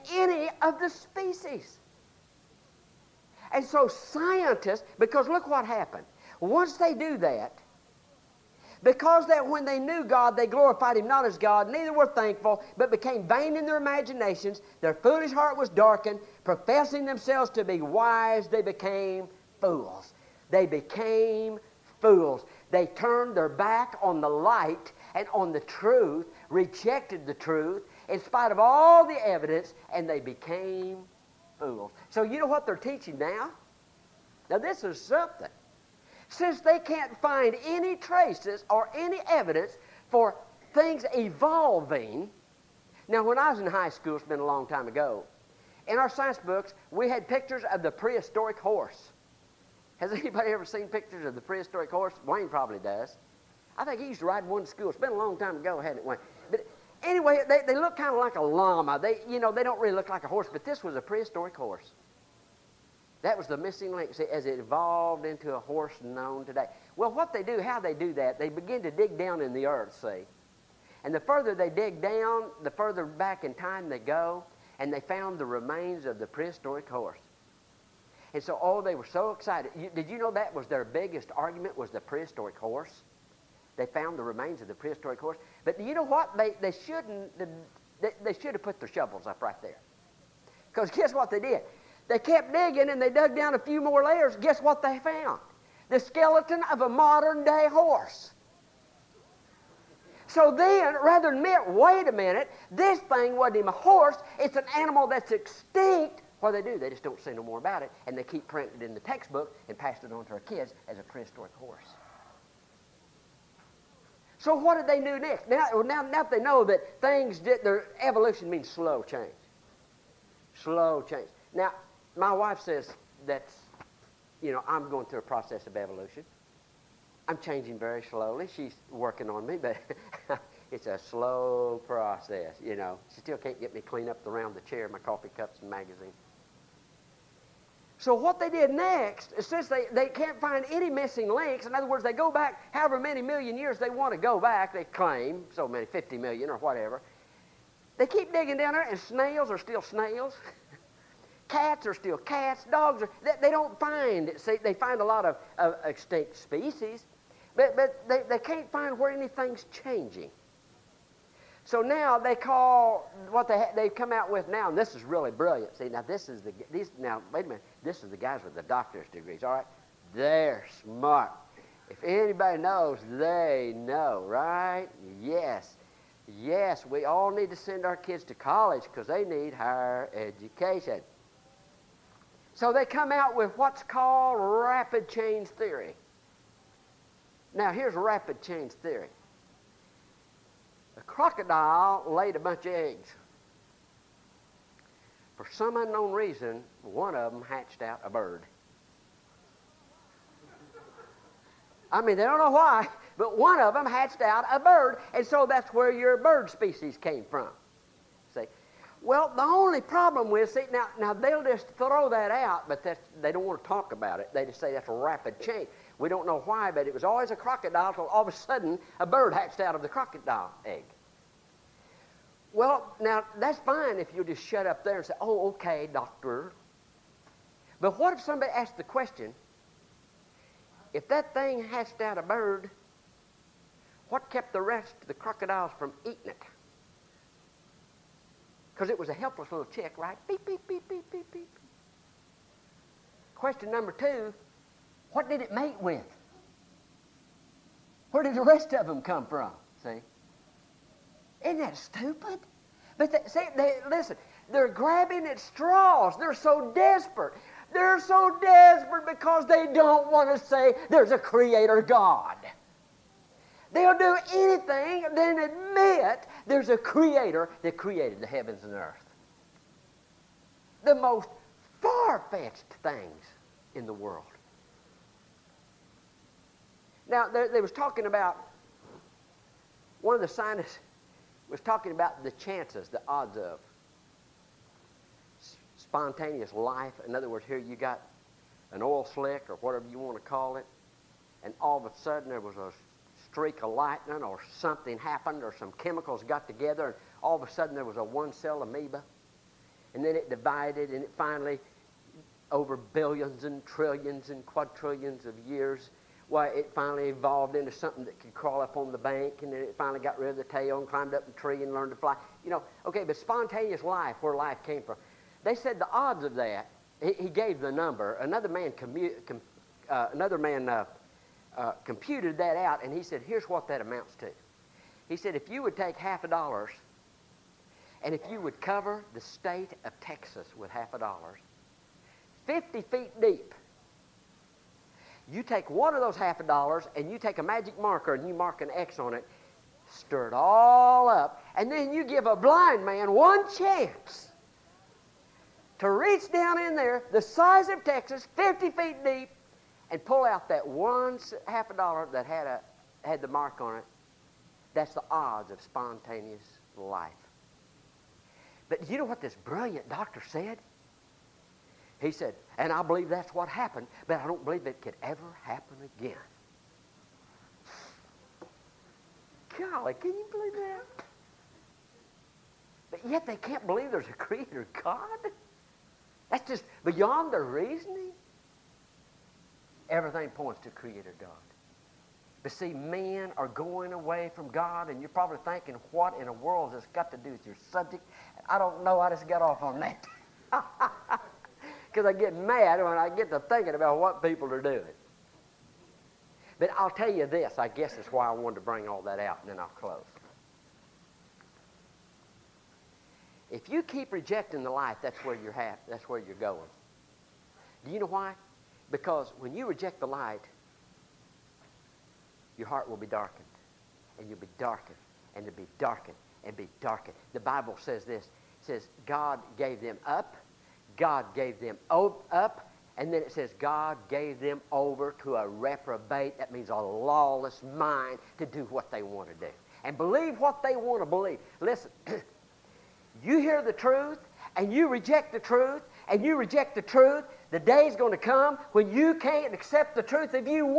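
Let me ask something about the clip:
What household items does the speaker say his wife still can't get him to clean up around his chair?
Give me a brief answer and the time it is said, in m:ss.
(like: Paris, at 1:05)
Coffee cups and magazine, at 2:14.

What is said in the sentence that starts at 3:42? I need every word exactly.
Well, now that's fine if you just shut up there and say, "Oh, okay, doctor." But what if somebody asked the question?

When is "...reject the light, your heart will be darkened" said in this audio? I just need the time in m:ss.
6:49.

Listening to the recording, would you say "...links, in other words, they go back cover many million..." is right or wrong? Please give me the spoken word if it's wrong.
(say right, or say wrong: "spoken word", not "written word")
wrong: "however", not "cover".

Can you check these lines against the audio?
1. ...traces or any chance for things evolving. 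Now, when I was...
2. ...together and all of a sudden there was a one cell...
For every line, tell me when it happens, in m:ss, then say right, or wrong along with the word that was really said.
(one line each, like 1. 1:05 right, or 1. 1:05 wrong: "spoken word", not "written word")
1. 0:37 wrong: "evidence", not "chance"
2. 4:56 right.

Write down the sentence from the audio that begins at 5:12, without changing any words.
You know, okay, but spontaneous life, where life came from.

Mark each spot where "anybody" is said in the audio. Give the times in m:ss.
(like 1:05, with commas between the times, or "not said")
0:50, 2:52.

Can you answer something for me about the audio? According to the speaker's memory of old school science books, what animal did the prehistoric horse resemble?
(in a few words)
A llama.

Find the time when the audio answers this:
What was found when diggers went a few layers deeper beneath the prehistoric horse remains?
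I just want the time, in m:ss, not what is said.
1:35.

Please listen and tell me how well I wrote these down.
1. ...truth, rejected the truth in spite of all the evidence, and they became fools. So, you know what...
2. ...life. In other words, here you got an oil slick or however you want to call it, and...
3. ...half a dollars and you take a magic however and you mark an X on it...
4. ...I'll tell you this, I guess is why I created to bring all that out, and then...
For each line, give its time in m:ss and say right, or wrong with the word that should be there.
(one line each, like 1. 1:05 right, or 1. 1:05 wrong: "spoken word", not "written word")
1. 0:25 right
2. 4:46 wrong: "whatever", not "however"
3. 5:36 wrong: "marker", not "however"
4. 6:36 wrong: "wanted", not "created".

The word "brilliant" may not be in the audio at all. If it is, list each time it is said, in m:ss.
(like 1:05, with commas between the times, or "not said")
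2:45, 5:59.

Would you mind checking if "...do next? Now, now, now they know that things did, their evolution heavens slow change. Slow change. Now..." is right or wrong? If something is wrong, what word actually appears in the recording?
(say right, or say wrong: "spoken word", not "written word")
wrong: "means", not "heavens".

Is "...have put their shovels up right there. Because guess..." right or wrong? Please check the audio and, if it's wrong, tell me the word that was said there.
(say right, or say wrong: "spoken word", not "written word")
right.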